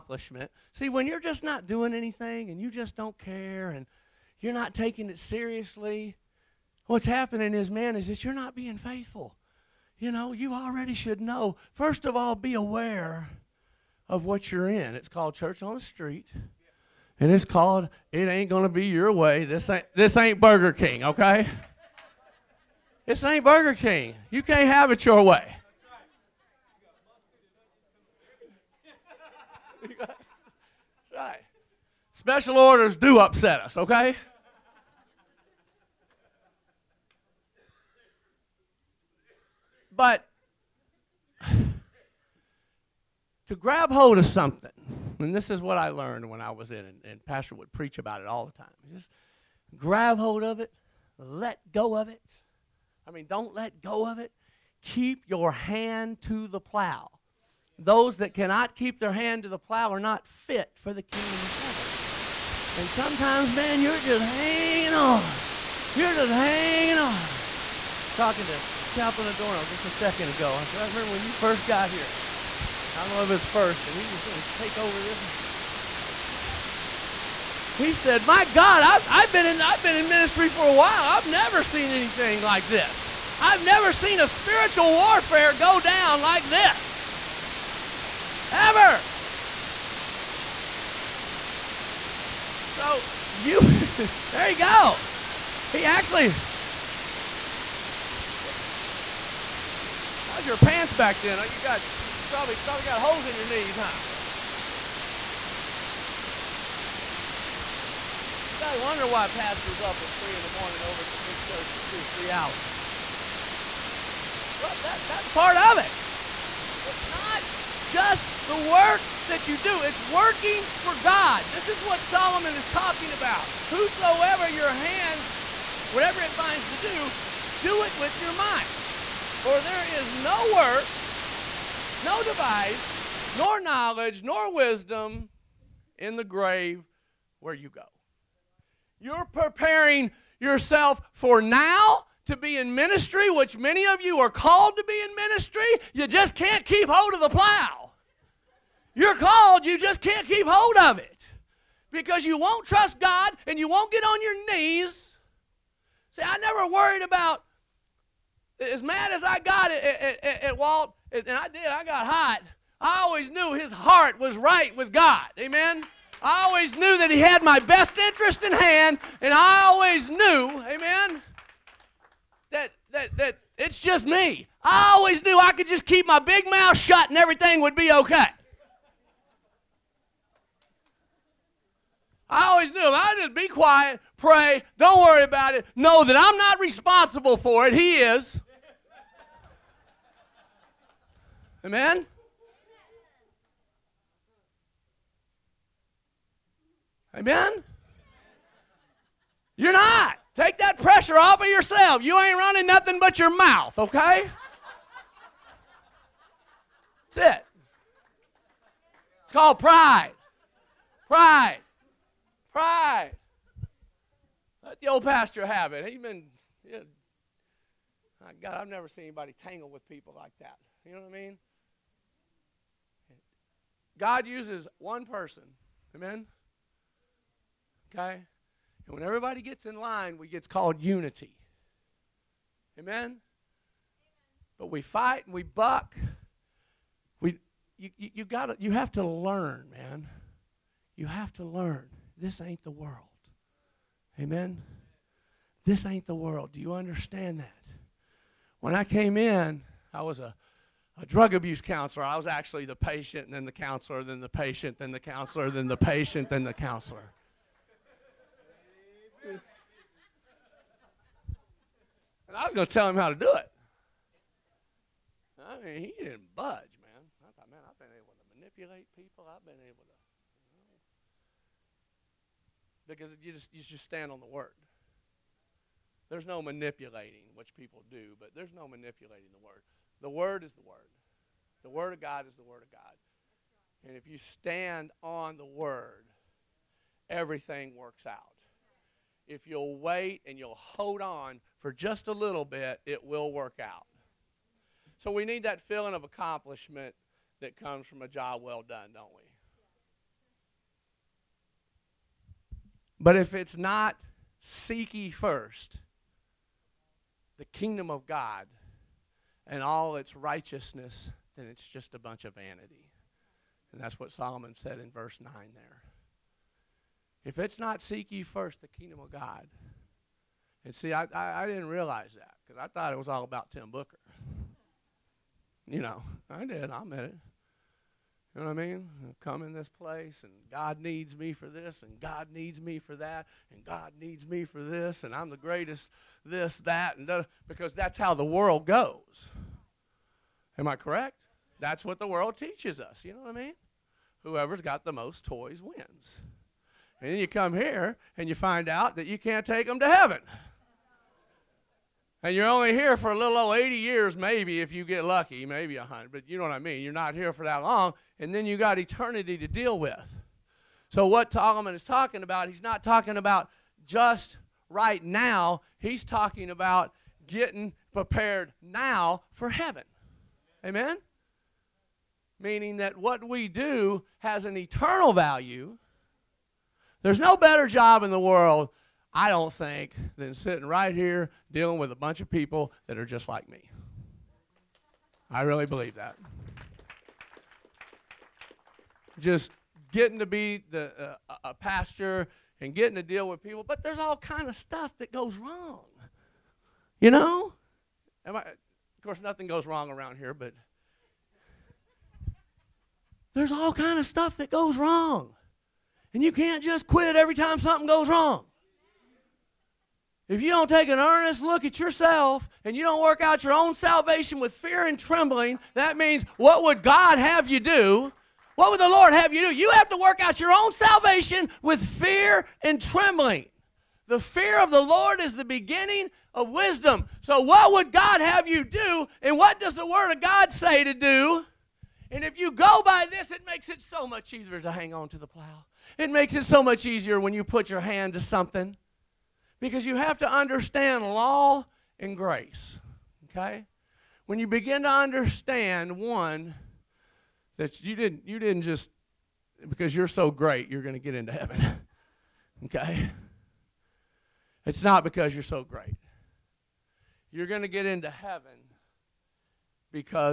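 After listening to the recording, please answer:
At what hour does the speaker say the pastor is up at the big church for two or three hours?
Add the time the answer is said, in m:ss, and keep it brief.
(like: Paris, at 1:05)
3 in the morning, at 1:50.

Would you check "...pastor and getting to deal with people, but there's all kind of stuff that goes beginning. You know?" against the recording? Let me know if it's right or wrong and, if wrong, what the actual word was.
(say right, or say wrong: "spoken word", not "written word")
wrong: "wrong", not "beginning".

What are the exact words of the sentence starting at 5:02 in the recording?
But if it's not seek ye first the kingdom of God, and all its righteousness, then it's just a bunch of vanity.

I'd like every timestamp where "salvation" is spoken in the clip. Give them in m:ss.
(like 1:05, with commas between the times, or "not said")
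6:53, 7:00.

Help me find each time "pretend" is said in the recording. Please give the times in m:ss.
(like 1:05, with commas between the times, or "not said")
not said.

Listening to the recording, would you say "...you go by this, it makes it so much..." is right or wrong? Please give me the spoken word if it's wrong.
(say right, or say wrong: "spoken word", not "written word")
right.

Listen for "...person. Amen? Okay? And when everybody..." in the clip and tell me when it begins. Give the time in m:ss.
3:45.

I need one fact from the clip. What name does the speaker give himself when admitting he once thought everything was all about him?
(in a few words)
Tim Booker.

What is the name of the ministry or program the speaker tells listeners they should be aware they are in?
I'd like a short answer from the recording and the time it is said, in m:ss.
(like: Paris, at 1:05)
Church on the Street, at 0:15.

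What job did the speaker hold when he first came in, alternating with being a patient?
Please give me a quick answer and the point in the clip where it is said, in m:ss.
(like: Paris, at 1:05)
Drug abuse counselor, at 4:11.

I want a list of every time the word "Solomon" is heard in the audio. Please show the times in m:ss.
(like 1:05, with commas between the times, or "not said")
2:02, 5:14, 6:01.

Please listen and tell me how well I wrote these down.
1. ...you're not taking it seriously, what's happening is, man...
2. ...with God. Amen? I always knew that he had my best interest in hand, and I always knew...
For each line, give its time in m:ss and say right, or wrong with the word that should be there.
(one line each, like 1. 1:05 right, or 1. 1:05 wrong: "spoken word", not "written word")
1. 0:04 right
2. 2:44 right.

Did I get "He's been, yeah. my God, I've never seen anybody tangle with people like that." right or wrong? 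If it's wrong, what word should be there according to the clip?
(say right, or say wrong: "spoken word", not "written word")
right.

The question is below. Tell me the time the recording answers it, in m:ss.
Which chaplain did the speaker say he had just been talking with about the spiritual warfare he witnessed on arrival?
1:08.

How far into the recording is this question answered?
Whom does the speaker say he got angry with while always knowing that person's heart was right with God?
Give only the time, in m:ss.
2:40.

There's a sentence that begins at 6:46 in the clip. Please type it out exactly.
And you can't just quit every time something goes wrong.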